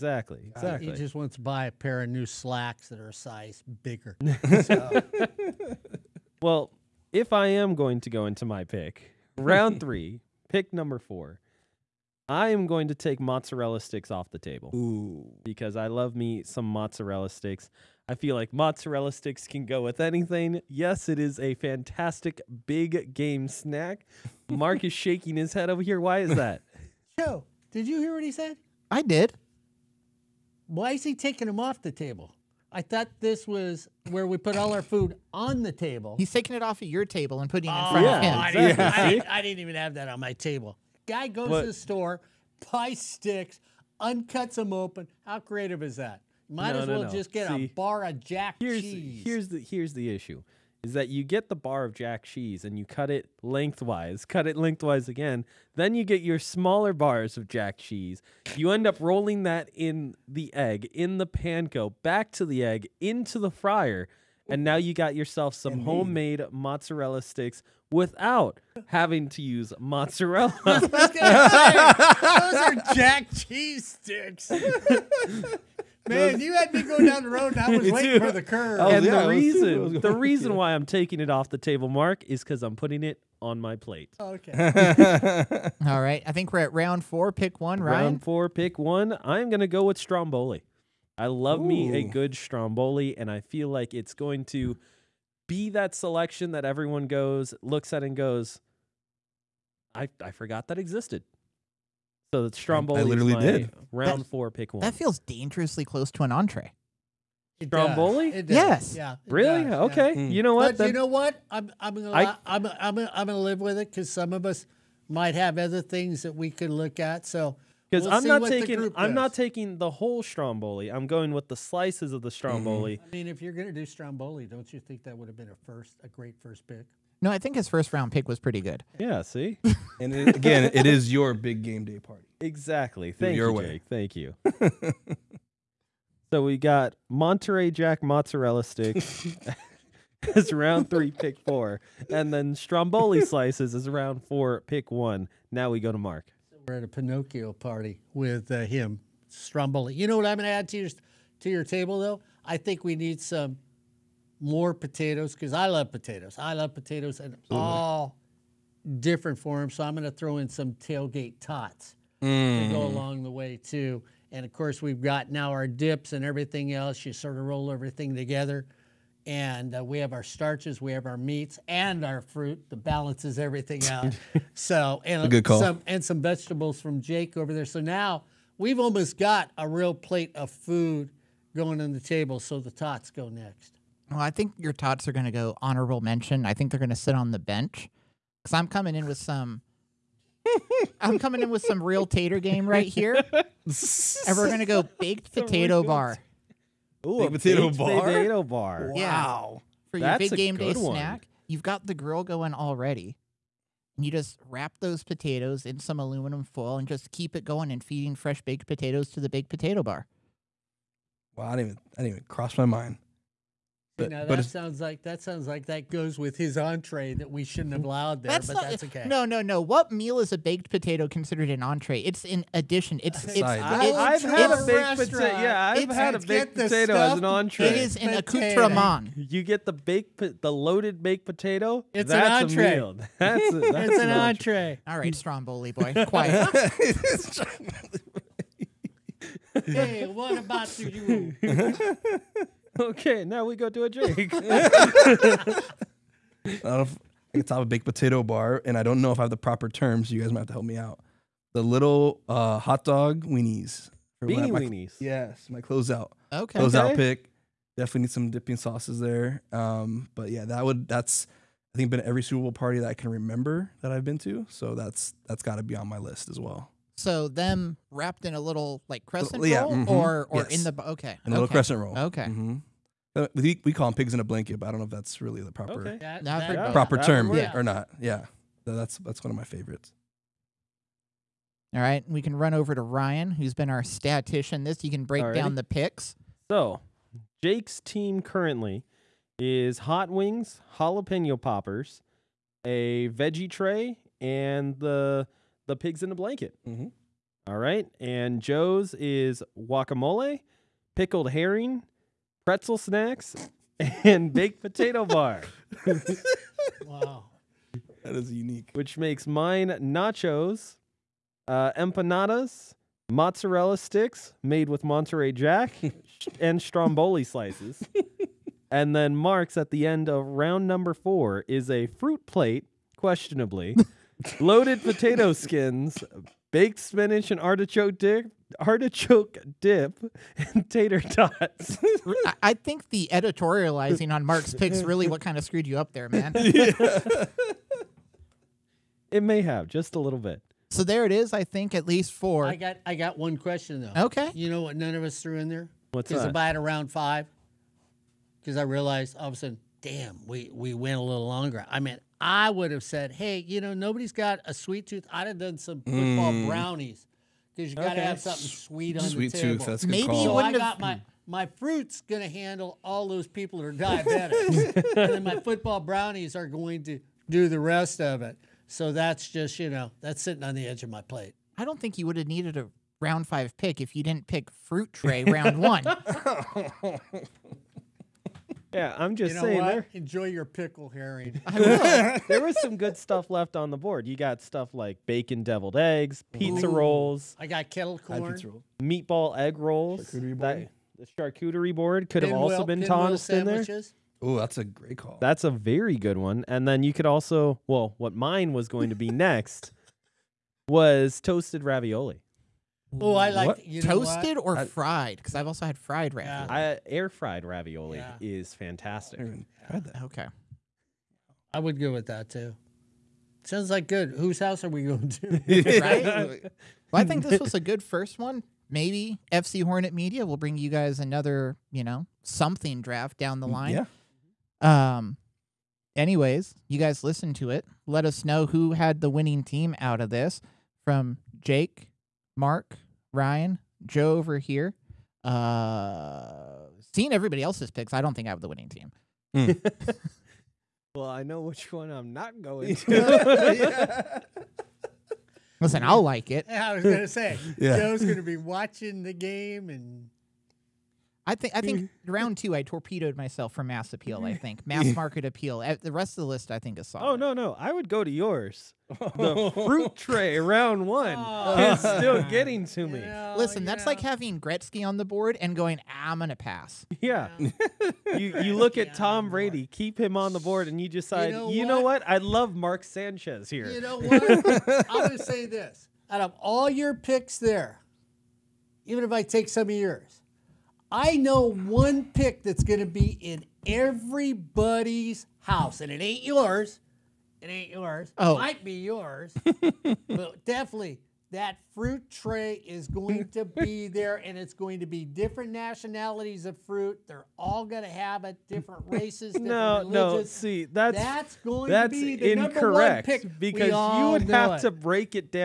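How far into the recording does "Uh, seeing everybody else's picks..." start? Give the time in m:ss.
7:15.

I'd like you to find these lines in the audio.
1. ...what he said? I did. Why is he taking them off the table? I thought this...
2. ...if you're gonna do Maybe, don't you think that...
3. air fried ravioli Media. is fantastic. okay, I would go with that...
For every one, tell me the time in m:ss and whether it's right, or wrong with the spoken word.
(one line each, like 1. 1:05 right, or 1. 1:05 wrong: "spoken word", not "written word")
1. 0:28 right
2. 2:03 wrong: "Stromboli", not "Maybe"
3. 6:46 wrong: "Yeah", not "Media".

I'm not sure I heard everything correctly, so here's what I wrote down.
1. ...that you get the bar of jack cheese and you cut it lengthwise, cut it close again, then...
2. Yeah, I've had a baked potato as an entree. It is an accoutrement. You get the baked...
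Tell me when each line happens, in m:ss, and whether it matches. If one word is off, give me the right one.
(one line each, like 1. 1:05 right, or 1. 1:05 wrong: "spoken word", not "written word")
1. 0:50 wrong: "lengthwise", not "close"
2. 3:45 right.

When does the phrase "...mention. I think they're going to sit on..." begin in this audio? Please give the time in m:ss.
3:05.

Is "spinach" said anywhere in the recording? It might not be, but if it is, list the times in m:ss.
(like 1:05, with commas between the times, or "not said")
5:26.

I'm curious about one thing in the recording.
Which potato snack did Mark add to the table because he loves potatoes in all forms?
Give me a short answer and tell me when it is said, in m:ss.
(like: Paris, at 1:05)
tailgate tots, at 2:40.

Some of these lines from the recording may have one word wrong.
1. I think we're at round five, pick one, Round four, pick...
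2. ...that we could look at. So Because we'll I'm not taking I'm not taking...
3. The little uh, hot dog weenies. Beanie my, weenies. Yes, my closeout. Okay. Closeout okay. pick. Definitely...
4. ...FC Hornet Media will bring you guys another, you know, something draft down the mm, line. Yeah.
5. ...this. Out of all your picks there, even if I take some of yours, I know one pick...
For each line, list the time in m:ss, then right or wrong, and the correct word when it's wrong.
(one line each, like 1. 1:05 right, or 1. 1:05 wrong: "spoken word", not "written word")
1. 1:26 wrong: "four", not "five"
2. 1:56 right
3. 4:11 right
4. 6:59 right
5. 7:55 right.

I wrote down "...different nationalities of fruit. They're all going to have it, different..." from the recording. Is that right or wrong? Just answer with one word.
right.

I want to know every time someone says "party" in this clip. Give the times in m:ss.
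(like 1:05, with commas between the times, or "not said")
2:11, 2:27, 4:22.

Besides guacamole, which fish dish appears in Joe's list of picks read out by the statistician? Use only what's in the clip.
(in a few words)
pickled herring.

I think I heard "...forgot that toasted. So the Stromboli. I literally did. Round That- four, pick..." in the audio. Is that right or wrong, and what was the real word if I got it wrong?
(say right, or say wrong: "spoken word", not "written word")
wrong: "existed", not "toasted".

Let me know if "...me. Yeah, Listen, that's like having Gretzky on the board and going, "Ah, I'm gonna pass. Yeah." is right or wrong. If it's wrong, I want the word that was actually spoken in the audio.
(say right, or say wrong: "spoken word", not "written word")
right.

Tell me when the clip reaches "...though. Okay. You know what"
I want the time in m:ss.
5:43.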